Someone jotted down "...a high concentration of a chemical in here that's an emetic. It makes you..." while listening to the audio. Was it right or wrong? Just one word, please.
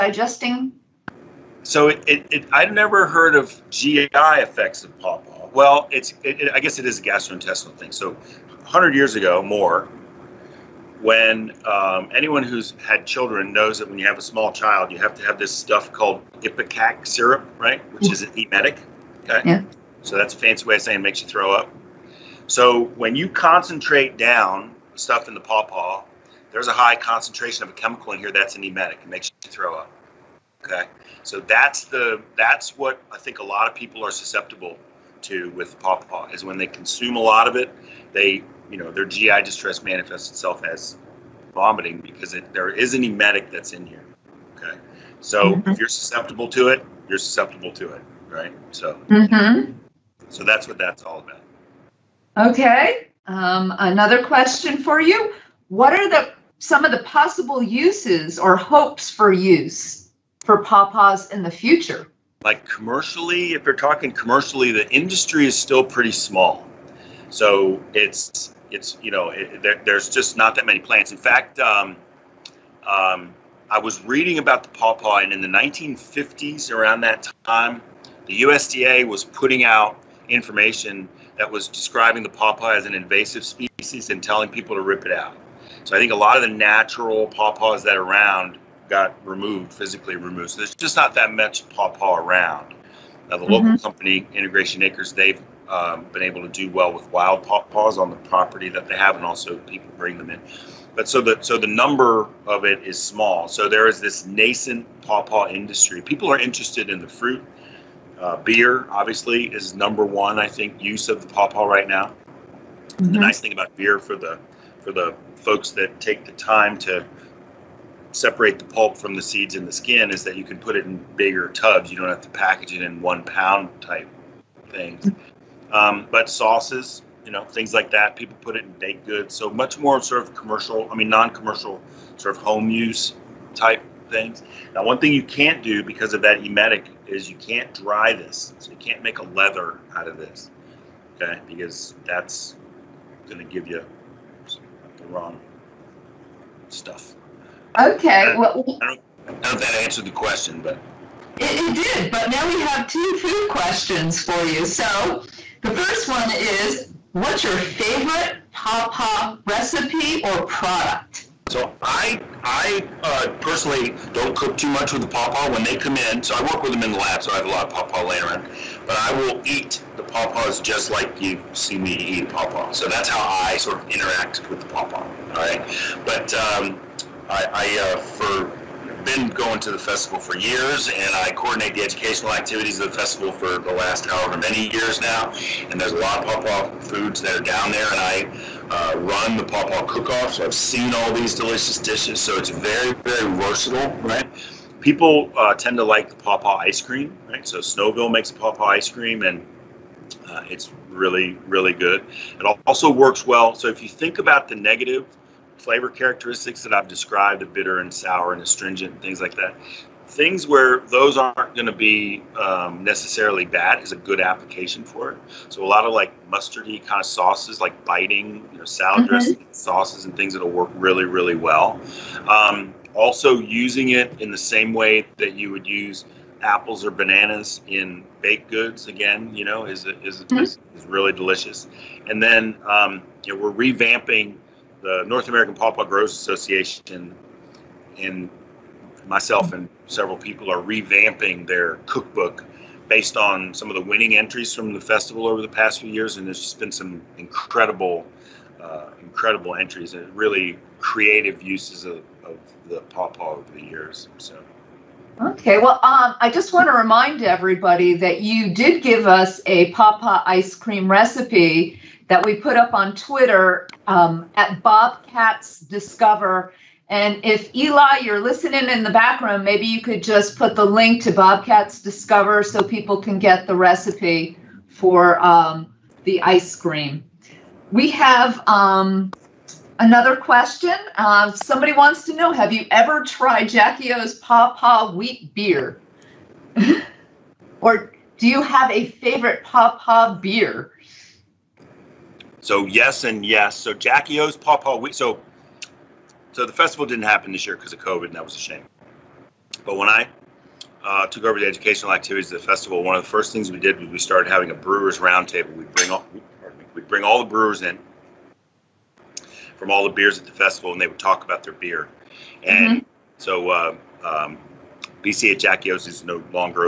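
right.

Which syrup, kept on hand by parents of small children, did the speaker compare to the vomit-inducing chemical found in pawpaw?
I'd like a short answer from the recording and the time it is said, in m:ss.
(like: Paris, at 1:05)
Ipecac syrup, at 0:16.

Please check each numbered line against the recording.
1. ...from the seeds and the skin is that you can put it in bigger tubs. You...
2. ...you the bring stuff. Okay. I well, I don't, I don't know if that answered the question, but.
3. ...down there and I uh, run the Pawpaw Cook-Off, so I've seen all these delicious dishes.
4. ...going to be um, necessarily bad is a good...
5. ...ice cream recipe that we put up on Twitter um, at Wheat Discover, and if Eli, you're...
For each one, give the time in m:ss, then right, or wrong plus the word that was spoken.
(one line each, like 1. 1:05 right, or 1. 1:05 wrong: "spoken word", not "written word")
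1. 1:58 right
2. 2:23 wrong: "wrong", not "bring"
3. 3:07 right
4. 3:31 right
5. 4:20 wrong: "Bobcats", not "Wheat".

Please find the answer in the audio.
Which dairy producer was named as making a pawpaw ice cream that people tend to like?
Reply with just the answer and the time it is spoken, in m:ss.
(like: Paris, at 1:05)
Snowville, at 3:17.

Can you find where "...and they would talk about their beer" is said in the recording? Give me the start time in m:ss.
5:10.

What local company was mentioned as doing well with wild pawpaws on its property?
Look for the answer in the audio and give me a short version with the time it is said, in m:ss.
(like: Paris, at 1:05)
Integration Acres, at 1:34.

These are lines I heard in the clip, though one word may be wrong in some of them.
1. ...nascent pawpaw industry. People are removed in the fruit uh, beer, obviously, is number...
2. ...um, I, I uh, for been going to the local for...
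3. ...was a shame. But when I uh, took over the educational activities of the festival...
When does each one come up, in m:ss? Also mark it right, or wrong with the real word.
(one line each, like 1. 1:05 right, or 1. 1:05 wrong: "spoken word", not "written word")
1. 1:44 wrong: "interested", not "removed"
2. 2:56 wrong: "festival", not "local"
3. 4:58 right.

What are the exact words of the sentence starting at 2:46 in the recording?
So I work with them in the lab, so I have a lot of pawpaw laying around.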